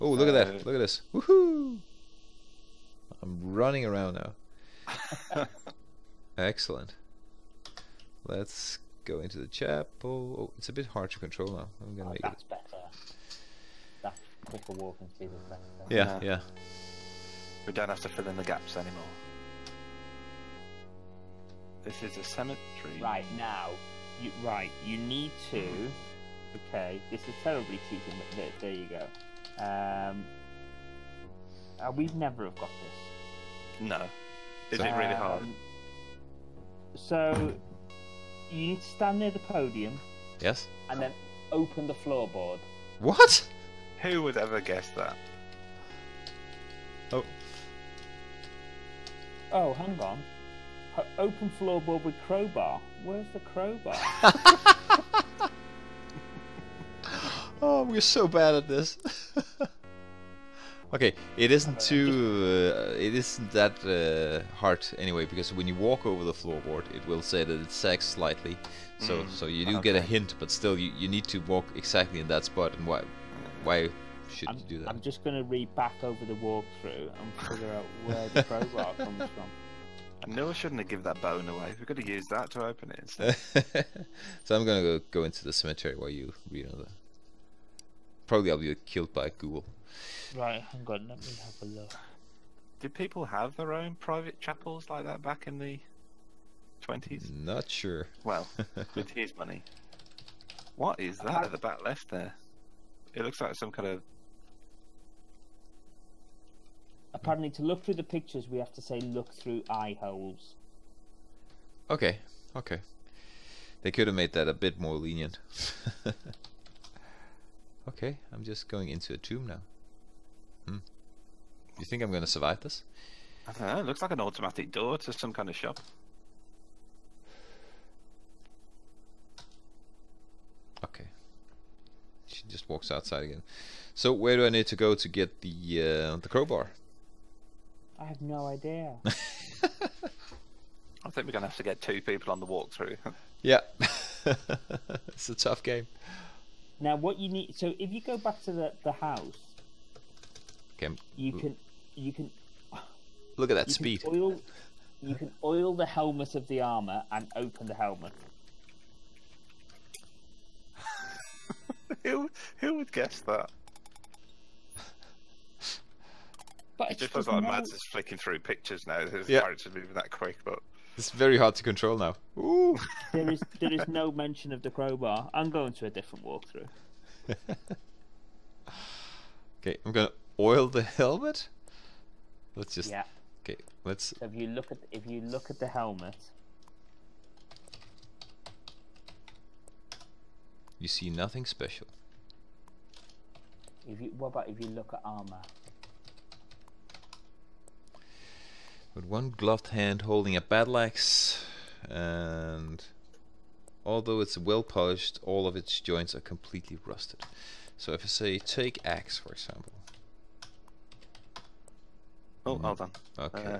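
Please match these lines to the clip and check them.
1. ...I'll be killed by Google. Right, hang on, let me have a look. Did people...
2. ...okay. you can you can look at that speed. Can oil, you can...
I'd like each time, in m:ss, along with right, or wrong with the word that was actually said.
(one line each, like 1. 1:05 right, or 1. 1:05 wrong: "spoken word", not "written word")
1. 1:28 right
2. 2:30 right.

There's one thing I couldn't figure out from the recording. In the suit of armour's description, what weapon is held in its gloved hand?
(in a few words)
A battle axe.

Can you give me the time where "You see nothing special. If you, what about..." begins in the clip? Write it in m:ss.
3:10.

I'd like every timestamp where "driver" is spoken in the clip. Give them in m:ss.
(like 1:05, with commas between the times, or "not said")
not said.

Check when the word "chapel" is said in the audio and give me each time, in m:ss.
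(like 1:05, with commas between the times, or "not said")
0:09, 1:34.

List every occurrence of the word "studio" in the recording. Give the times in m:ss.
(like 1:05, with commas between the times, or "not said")
not said.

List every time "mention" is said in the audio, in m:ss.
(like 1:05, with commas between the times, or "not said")
2:54.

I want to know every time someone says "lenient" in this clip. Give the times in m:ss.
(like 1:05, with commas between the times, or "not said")
1:54.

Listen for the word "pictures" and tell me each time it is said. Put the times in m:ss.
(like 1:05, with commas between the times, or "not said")
1:48, 2:48.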